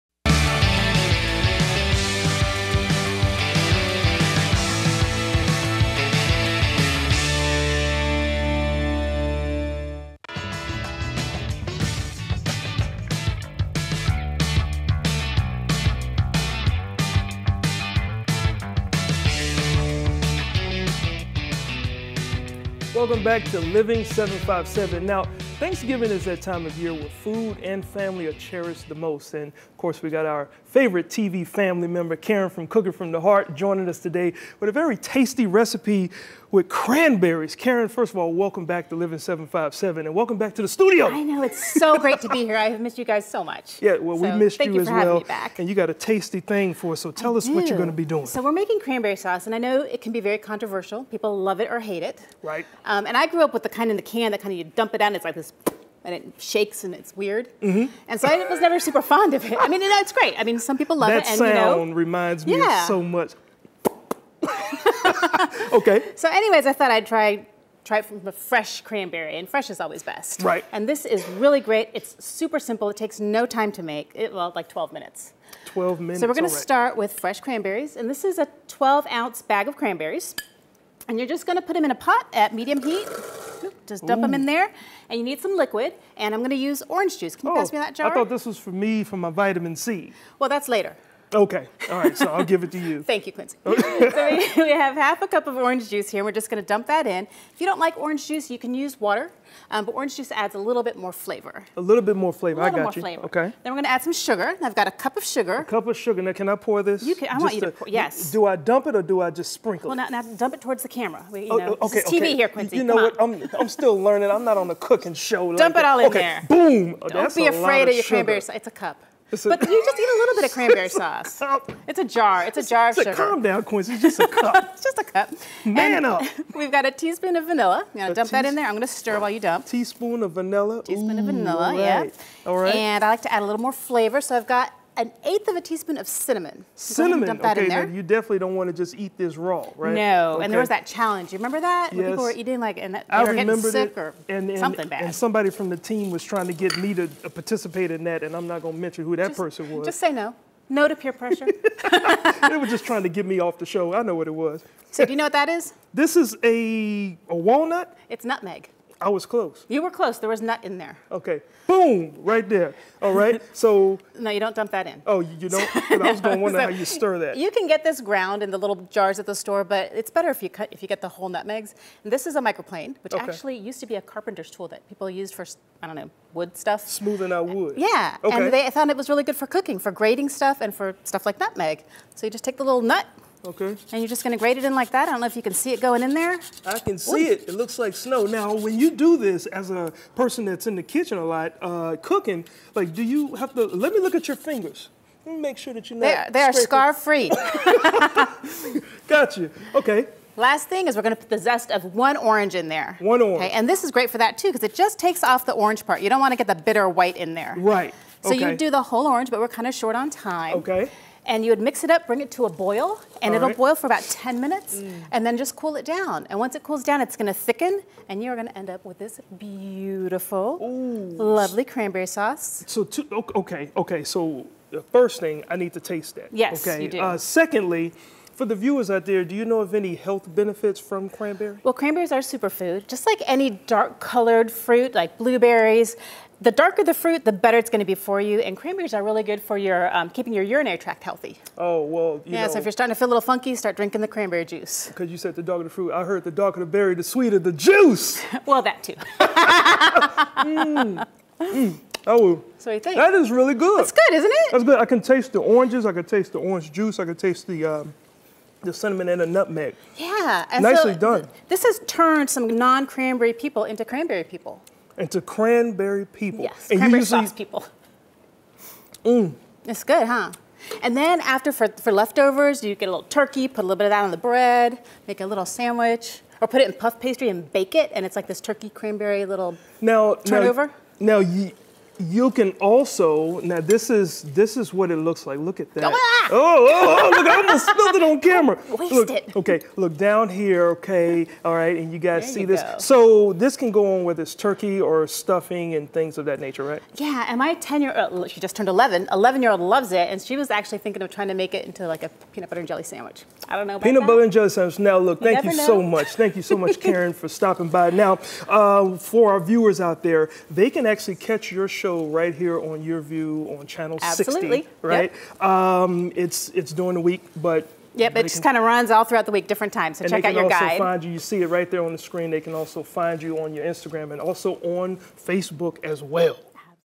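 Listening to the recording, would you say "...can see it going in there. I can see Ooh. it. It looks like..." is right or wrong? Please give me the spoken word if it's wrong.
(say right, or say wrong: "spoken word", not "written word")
right.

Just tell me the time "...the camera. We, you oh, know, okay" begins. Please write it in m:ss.
1:50.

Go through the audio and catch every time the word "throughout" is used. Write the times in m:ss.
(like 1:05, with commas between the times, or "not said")
5:19.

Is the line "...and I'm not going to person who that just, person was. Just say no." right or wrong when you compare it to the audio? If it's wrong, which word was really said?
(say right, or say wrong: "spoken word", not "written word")
wrong: "mention", not "person".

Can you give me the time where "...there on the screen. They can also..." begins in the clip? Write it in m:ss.
5:21.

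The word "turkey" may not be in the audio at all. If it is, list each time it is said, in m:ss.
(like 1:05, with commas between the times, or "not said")
4:33, 4:38, 4:54.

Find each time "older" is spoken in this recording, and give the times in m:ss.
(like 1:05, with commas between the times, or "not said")
not said.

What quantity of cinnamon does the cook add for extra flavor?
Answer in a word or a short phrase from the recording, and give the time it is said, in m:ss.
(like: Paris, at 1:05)
1/8 teaspoon, at 2:14.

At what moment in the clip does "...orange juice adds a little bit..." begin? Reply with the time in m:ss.
1:39.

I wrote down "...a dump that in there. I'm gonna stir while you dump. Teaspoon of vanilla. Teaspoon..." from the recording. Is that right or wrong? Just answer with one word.
right.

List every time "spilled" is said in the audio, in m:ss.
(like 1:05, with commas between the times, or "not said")
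4:47.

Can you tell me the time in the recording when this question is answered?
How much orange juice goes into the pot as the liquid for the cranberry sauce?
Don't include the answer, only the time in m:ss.
1:34.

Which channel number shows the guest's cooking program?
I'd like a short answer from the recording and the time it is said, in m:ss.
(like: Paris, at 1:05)
60, at 5:14.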